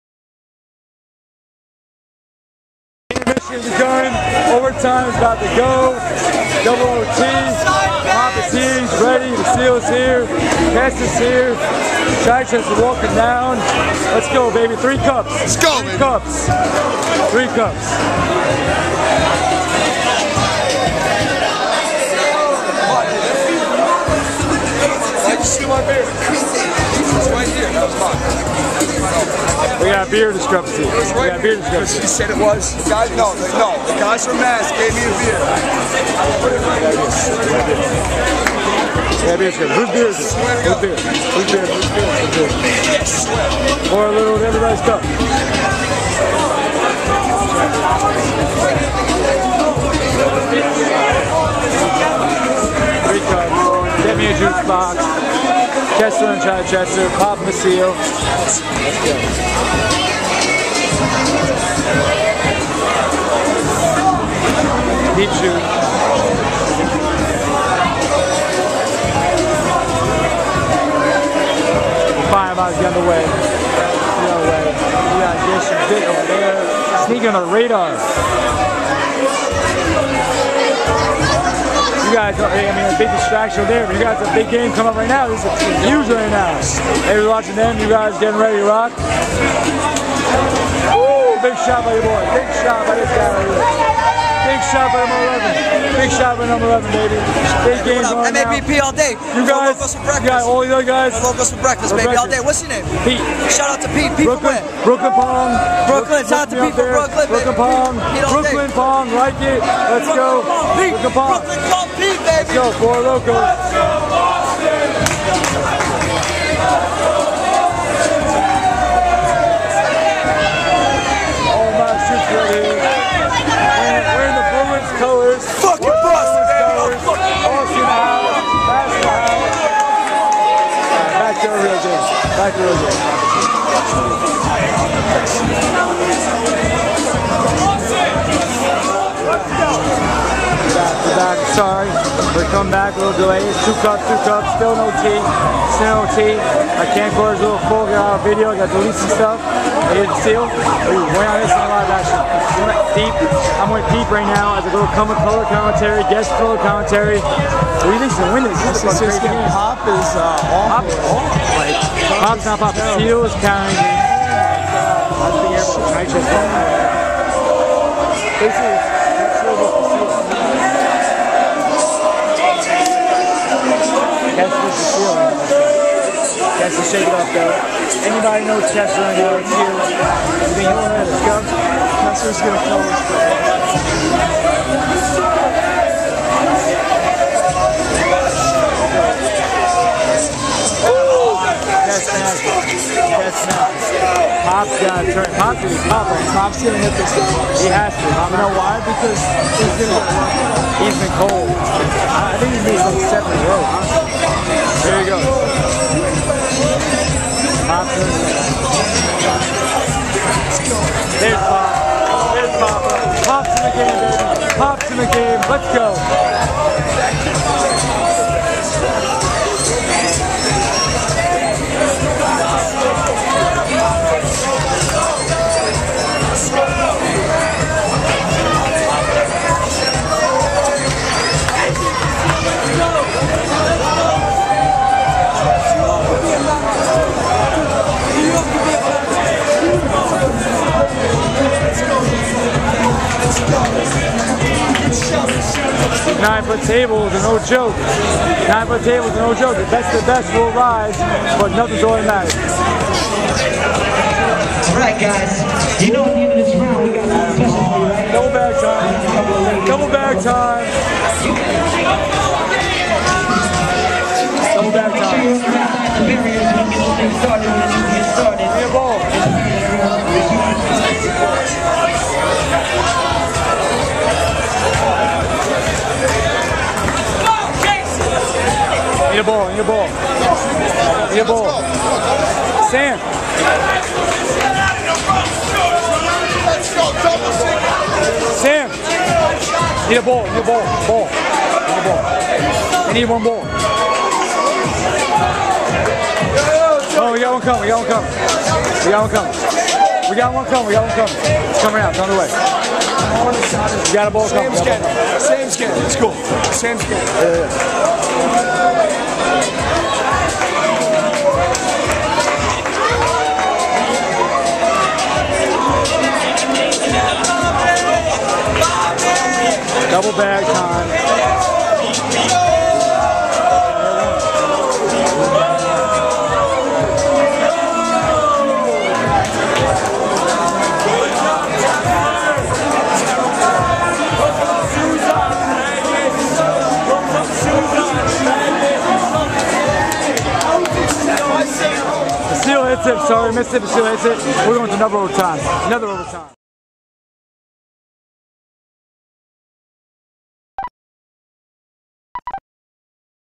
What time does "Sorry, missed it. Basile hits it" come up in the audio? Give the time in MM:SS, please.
05:43.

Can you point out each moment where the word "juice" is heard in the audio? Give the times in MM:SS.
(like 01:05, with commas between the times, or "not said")
00:54.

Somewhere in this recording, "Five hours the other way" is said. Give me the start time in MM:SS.
01:12.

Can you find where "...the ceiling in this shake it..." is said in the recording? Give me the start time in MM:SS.
02:54.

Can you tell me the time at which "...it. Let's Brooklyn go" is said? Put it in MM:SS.
01:49.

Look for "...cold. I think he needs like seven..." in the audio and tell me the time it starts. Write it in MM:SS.
03:21.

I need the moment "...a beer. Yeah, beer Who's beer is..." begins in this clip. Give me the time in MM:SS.
00:35.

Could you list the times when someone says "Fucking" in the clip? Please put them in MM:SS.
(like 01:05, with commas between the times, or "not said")
02:05.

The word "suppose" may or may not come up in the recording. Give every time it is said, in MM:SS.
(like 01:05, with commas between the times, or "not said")
not said.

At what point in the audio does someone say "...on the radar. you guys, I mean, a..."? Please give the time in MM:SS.
01:17.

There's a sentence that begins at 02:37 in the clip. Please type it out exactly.
What do you think's gonna win this?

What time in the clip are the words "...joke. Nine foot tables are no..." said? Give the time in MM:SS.
04:07.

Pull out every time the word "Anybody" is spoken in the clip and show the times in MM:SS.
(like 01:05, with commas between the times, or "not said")
02:58.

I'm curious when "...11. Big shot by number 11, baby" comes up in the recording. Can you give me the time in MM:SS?
01:35.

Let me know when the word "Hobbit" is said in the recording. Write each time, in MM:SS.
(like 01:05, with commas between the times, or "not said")
00:08.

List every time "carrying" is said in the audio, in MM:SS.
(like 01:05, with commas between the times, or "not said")
02:43.